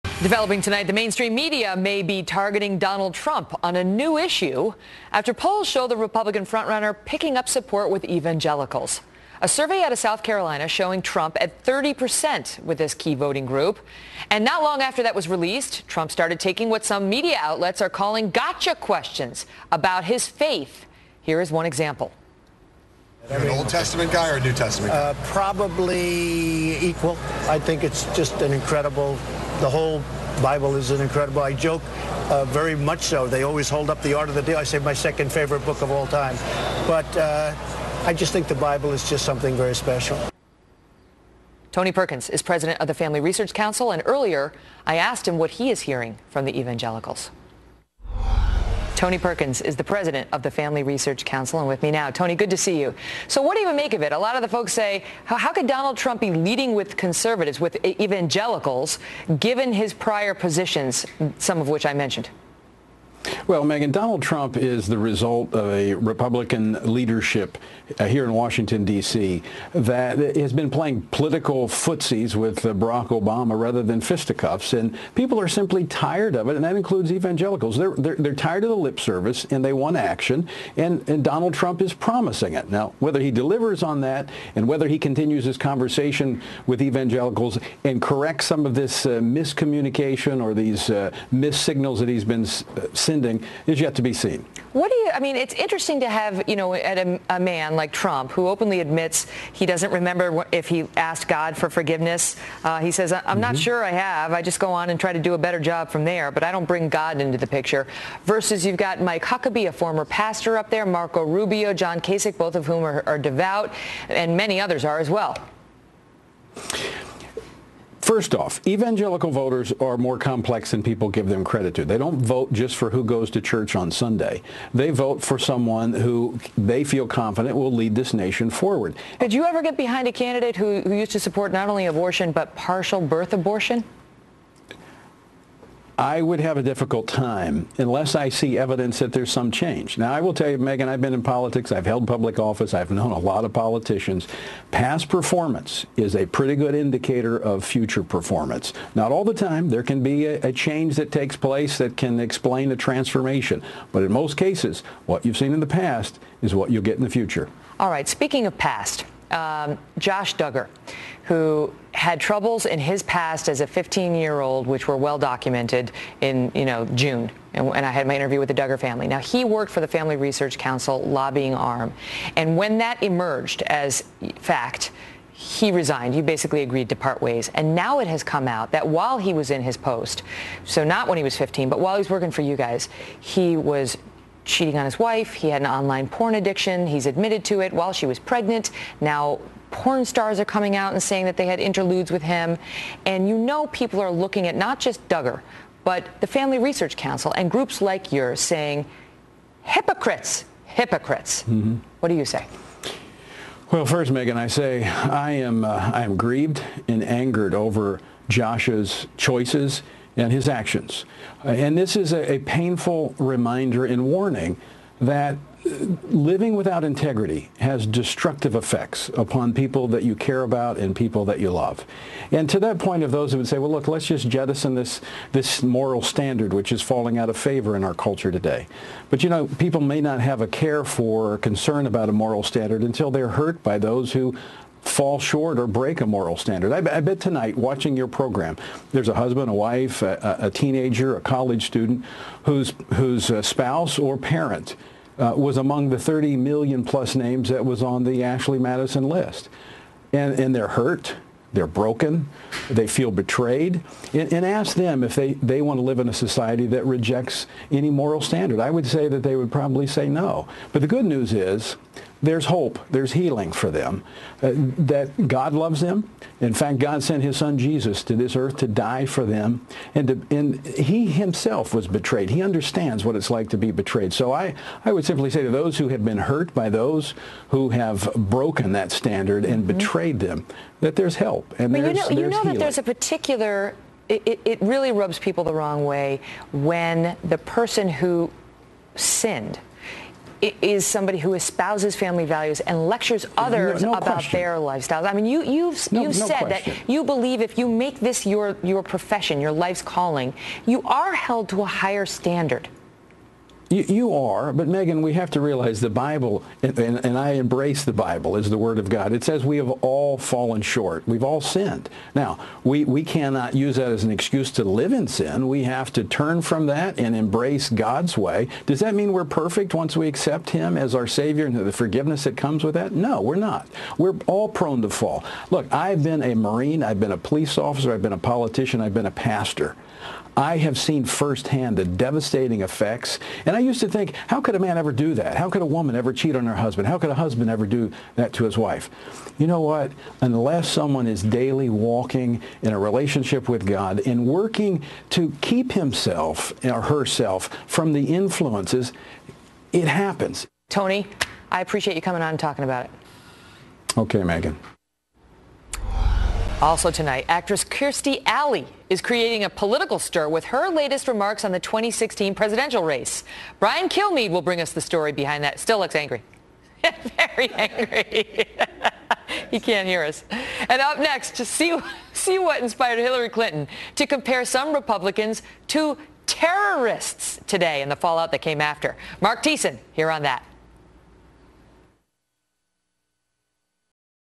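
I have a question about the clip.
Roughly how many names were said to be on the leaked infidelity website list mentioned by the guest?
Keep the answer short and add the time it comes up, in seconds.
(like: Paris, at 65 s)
30 million, at 245 s.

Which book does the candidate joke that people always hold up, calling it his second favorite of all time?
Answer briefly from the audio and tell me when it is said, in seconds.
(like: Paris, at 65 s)
The Art of the Deal, at 34 s.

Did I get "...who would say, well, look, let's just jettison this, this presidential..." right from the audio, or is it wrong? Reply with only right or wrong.
wrong.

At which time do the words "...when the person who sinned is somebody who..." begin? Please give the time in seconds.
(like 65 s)
286 s.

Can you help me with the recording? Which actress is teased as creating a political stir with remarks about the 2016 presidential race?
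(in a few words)
Kirstie Alley.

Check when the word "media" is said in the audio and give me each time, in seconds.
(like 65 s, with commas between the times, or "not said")
1 s, 17 s.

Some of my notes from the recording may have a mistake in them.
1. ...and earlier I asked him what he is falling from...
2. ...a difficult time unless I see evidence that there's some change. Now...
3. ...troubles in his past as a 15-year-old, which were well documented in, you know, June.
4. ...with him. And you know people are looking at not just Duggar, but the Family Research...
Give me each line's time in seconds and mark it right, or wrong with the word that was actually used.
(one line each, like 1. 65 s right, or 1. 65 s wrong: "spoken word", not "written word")
1. 43 s wrong: "hearing", not "falling"
2. 136 s right
3. 162 s right
4. 192 s right.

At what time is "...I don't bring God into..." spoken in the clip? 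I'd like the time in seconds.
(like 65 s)
106 s.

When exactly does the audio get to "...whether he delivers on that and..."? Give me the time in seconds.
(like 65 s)
82 s.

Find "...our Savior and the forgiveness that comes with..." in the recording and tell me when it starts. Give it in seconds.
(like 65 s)
320 s.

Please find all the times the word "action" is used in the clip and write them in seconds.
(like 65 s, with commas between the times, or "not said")
79 s, 210 s.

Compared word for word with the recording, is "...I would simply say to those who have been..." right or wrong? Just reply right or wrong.
right.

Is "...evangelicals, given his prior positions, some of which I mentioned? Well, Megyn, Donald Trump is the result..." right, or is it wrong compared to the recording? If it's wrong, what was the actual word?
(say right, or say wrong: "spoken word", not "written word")
right.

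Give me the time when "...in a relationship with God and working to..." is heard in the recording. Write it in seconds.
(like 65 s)
342 s.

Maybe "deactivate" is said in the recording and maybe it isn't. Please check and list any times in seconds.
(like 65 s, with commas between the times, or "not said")
not said.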